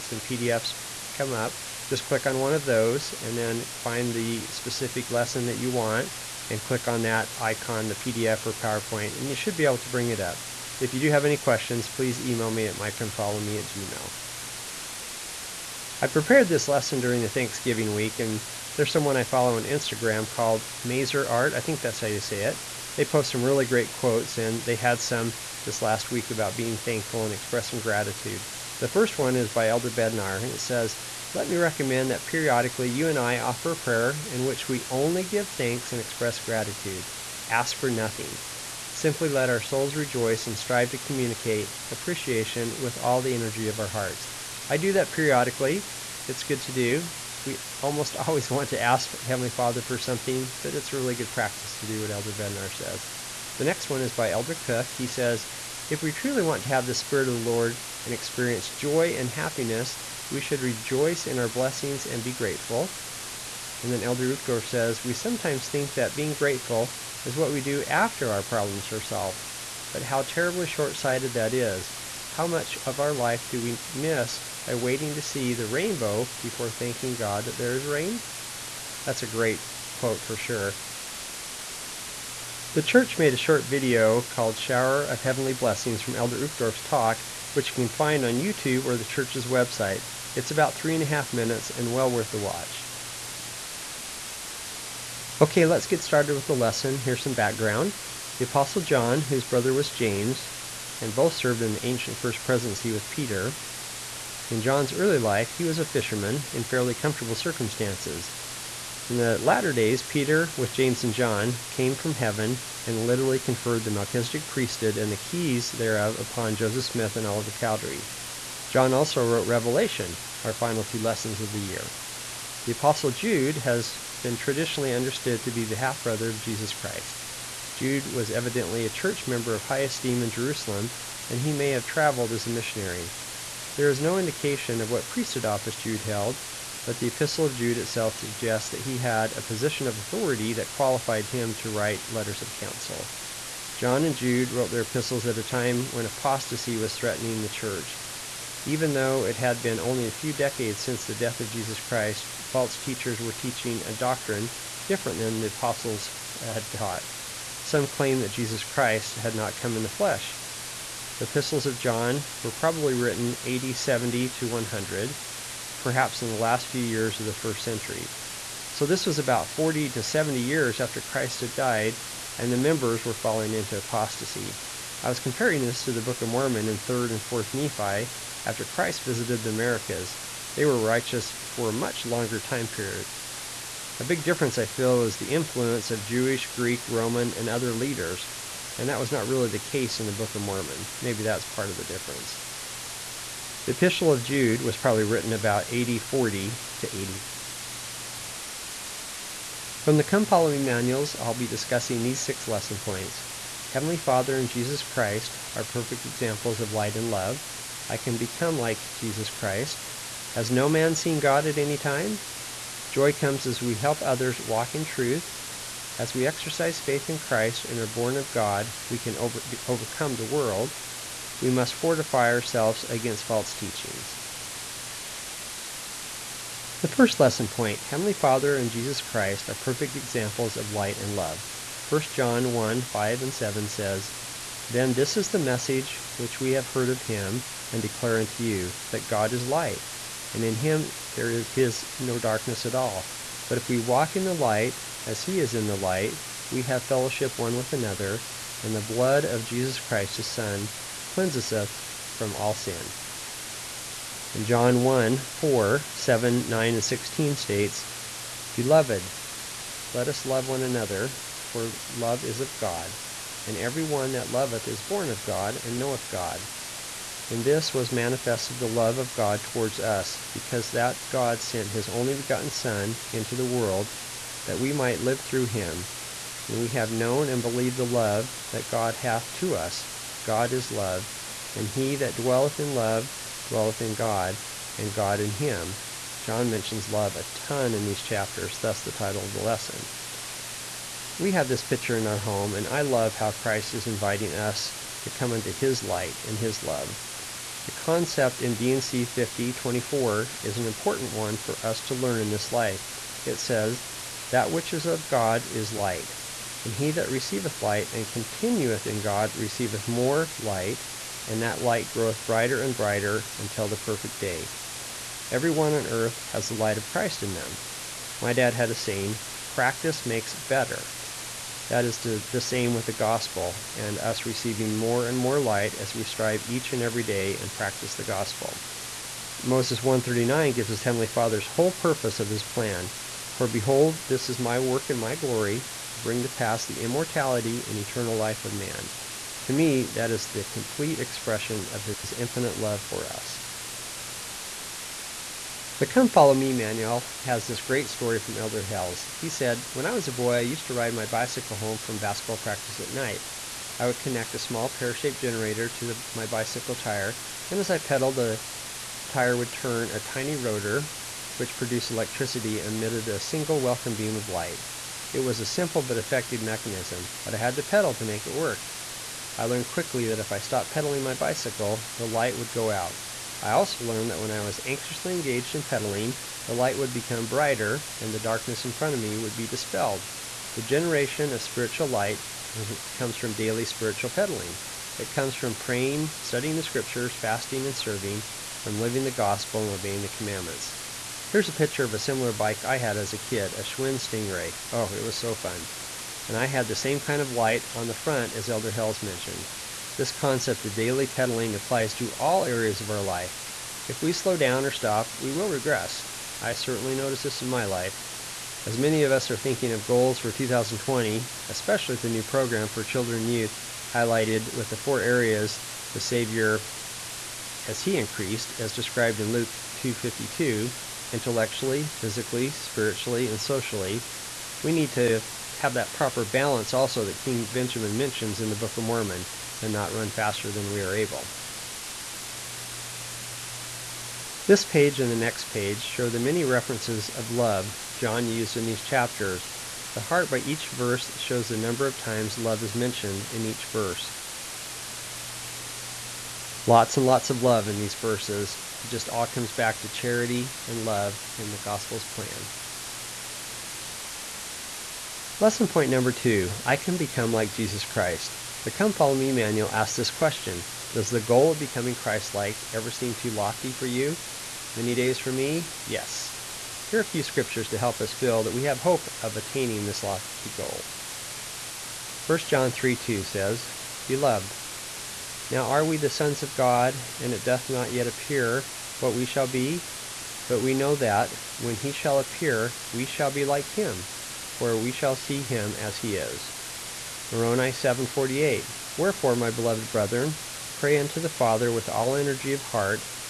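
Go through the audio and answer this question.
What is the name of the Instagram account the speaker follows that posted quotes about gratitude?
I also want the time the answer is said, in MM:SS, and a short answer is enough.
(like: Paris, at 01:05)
Mazer Art, at 00:20.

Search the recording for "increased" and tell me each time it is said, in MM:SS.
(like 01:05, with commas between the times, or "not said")
06:57.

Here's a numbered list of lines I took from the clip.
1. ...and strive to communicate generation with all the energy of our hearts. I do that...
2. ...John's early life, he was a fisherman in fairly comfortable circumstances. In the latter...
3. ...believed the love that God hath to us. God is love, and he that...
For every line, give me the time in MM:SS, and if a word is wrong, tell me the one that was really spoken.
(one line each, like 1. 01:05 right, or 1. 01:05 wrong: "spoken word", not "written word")
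1. 00:40 wrong: "appreciation", not "generation"
2. 01:44 right
3. 04:37 right.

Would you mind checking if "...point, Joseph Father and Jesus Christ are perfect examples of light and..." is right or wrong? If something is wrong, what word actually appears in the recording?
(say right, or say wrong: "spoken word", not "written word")
wrong: "Heavenly", not "Joseph".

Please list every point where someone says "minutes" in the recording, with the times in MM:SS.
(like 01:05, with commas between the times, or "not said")
01:31.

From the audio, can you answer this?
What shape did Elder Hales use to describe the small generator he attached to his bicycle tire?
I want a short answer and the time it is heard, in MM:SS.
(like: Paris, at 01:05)
pear-shaped, at 05:54.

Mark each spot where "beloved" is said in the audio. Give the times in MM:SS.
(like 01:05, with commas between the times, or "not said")
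04:18, 07:54, 08:09.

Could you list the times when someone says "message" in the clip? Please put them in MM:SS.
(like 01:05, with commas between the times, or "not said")
03:55.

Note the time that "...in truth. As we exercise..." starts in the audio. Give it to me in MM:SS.
03:34.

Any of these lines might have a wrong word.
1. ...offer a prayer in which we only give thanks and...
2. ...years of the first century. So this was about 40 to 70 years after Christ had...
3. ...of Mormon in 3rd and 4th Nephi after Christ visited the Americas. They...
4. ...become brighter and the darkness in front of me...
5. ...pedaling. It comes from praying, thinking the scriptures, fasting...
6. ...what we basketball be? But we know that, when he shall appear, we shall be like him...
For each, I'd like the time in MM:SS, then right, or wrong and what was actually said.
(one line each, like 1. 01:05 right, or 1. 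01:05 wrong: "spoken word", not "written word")
1. 00:33 right
2. 02:46 right
3. 02:56 right
4. 06:16 right
5. 06:24 wrong: "studying", not "thinking"
6. 07:59 wrong: "shall", not "basketball".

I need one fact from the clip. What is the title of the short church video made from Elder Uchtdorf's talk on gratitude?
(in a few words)
Shower of Heavenly Blessings.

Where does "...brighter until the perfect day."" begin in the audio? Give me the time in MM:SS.
05:12.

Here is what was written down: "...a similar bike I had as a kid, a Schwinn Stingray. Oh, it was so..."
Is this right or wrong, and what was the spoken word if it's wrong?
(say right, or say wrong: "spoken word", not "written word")
right.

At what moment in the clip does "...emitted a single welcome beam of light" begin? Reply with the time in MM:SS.
06:02.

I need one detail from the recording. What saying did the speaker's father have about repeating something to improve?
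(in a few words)
Practice makes better.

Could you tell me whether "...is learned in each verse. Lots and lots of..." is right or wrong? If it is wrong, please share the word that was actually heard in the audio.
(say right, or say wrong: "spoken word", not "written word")
wrong: "mentioned", not "learned".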